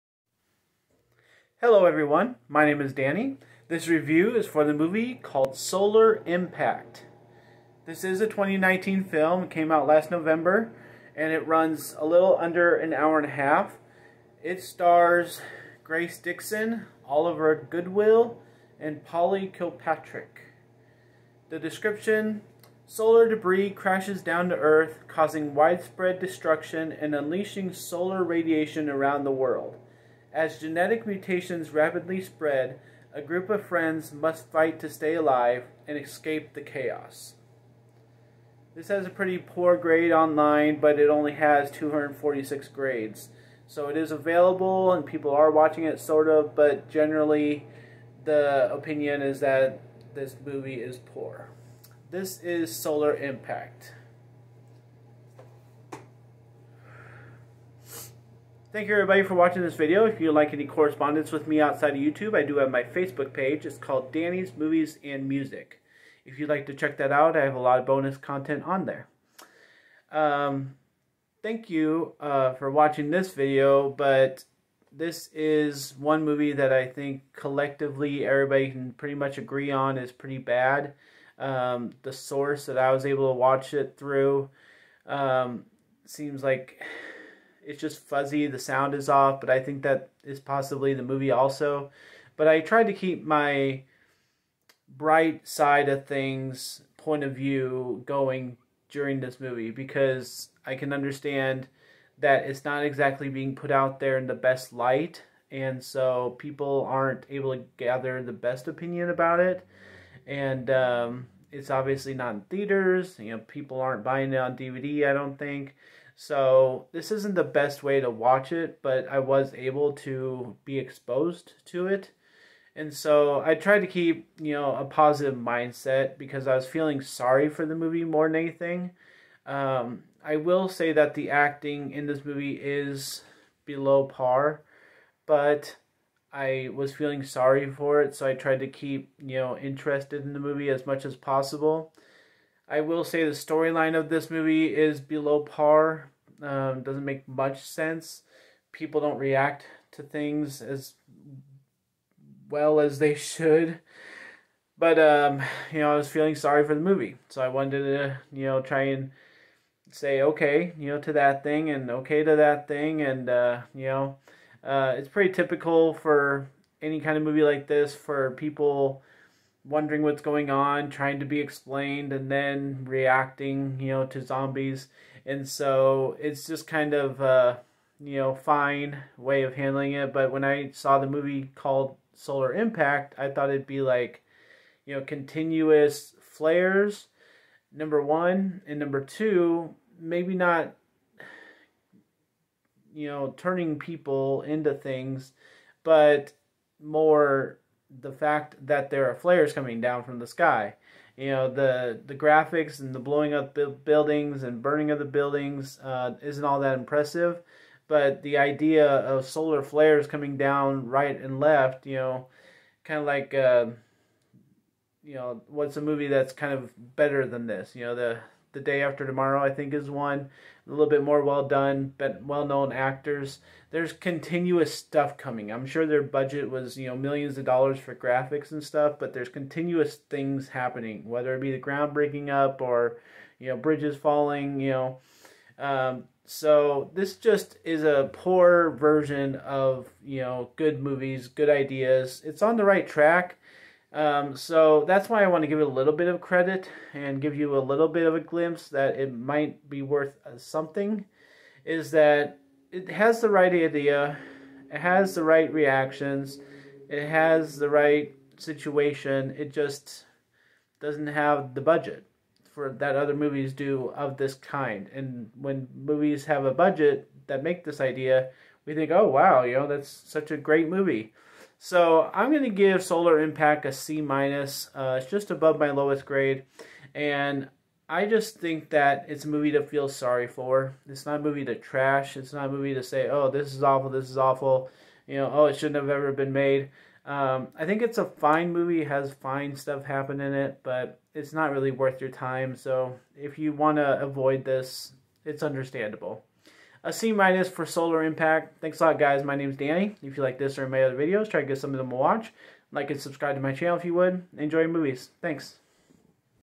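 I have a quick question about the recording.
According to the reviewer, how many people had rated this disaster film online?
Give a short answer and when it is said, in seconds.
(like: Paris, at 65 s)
246, at 41 s.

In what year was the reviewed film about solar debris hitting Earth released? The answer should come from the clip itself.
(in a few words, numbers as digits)
2019.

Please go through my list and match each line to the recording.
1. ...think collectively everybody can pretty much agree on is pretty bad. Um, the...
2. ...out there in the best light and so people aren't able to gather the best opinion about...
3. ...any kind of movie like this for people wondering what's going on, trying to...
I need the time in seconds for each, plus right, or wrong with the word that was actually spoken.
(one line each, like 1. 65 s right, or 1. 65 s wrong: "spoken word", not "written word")
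1. 76 s right
2. 103 s right
3. 166 s right.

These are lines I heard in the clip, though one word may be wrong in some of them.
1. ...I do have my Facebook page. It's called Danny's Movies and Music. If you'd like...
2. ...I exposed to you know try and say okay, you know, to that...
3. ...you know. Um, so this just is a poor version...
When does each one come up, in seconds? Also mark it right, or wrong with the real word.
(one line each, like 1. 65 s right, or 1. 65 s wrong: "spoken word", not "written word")
1. 62 s right
2. 157 s wrong: "wanted", not "exposed"
3. 234 s right.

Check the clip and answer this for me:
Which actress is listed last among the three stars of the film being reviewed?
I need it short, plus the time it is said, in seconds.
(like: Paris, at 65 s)
Polly Kilpatrick, at 19 s.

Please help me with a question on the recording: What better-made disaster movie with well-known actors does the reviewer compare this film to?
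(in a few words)
The Day After Tomorrow.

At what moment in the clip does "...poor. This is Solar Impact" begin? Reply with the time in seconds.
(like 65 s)
50 s.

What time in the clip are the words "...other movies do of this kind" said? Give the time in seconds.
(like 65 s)
262 s.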